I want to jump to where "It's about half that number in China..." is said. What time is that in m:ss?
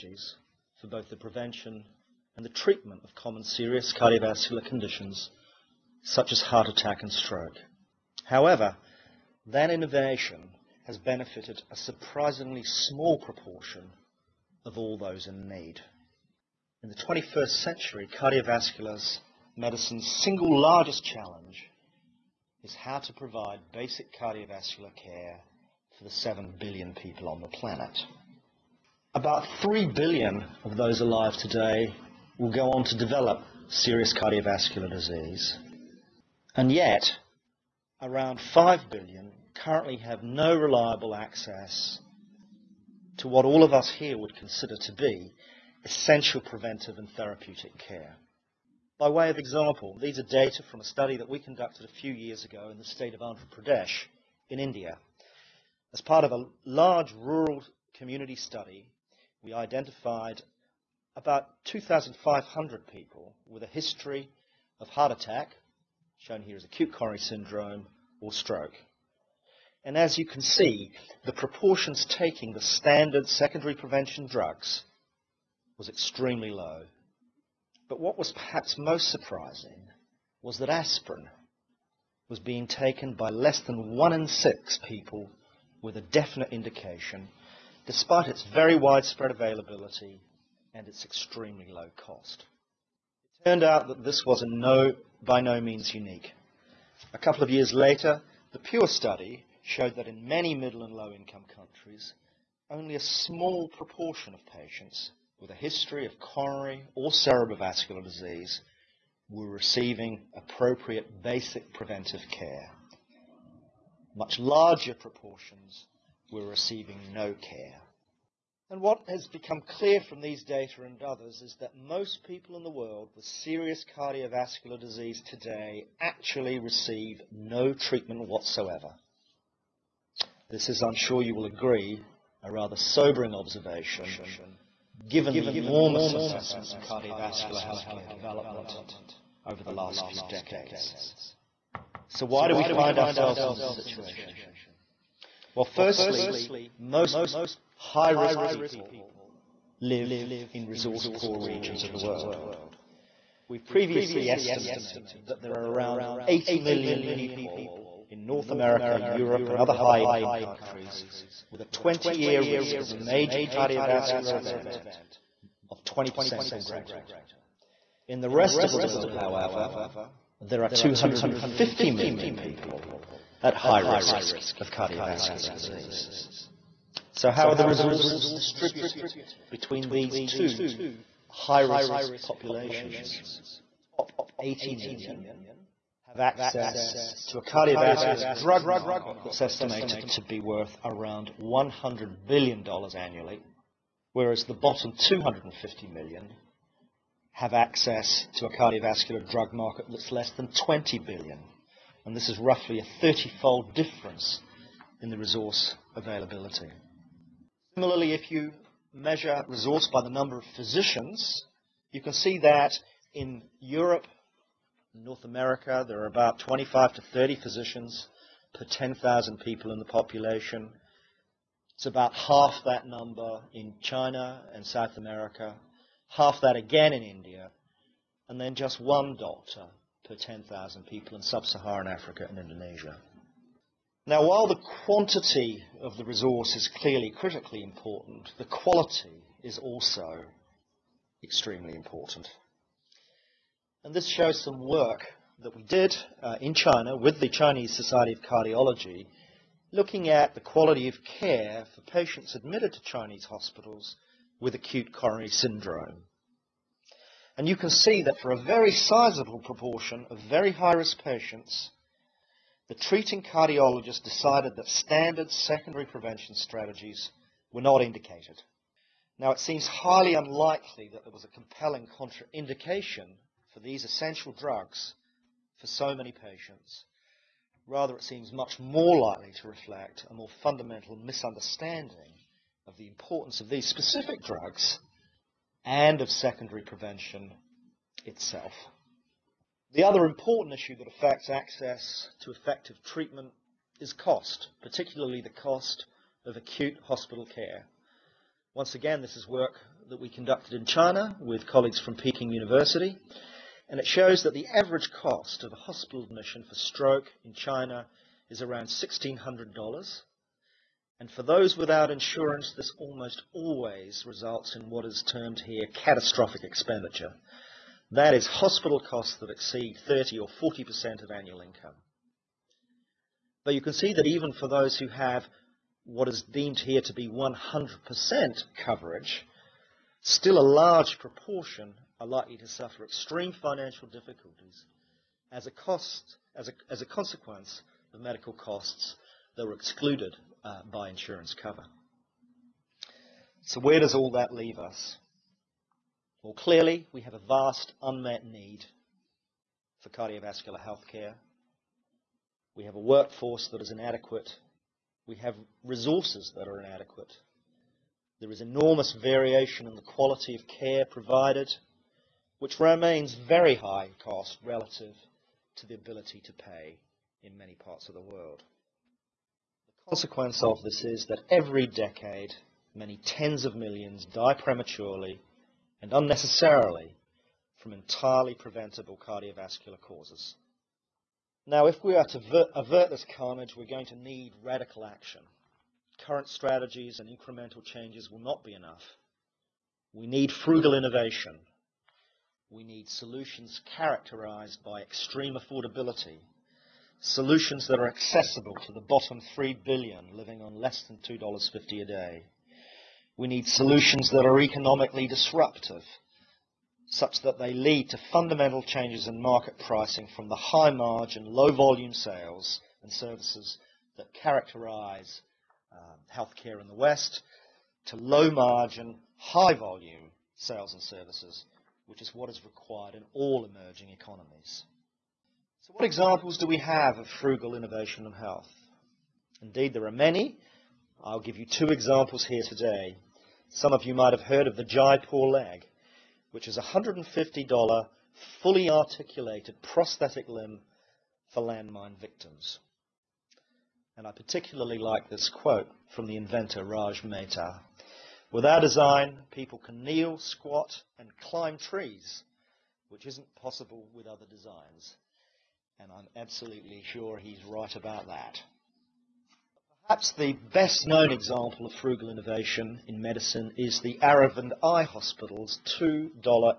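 3:41.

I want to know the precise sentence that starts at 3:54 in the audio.
Now, while the quantity of the resource is clearly critically important, the quality is also extremely important.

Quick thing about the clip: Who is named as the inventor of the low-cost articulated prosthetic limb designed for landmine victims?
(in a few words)
Raj Mehta.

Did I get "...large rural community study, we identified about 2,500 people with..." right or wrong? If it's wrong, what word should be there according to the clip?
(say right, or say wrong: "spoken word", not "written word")
right.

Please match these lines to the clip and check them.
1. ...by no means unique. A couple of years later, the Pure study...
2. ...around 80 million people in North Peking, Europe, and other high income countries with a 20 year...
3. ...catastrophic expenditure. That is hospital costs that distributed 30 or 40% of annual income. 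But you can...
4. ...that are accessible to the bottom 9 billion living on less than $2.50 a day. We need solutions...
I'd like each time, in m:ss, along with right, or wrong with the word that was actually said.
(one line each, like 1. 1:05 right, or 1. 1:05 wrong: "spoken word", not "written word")
1. 1:35 right
2. 2:35 wrong: "America", not "Peking"
3. 5:15 wrong: "exceed", not "distributed"
4. 6:37 wrong: "3", not "9".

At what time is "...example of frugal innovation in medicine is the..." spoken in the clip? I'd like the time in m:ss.
7:41.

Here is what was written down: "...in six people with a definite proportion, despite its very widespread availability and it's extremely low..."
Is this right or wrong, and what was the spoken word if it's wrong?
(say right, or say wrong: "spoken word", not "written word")
wrong: "indication", not "proportion".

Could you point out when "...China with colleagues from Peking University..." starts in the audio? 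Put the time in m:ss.
5:00.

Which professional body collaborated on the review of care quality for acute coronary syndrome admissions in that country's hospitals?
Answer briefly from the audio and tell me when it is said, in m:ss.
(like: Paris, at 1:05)
Chinese Society of Cardiology, at 4:07.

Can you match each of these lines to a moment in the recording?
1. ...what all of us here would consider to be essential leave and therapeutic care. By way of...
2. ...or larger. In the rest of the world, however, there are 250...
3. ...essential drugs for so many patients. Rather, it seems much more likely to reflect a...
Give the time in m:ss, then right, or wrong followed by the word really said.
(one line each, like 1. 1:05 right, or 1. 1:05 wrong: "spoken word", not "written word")
1. 0:43 wrong: "preventive", not "leave"
2. 2:46 wrong: "greater", not "larger"
3. 4:33 right.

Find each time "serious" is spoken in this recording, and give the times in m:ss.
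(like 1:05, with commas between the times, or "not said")
0:03, 0:33, 2:03.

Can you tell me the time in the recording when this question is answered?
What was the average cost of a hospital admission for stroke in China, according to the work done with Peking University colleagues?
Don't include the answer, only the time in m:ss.
5:08.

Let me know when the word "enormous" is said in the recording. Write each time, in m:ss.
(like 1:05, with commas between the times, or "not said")
2:15, 5:58.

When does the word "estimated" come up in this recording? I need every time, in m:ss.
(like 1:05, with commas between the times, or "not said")
2:34, 3:09.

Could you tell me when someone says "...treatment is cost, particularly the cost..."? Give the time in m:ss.
4:52.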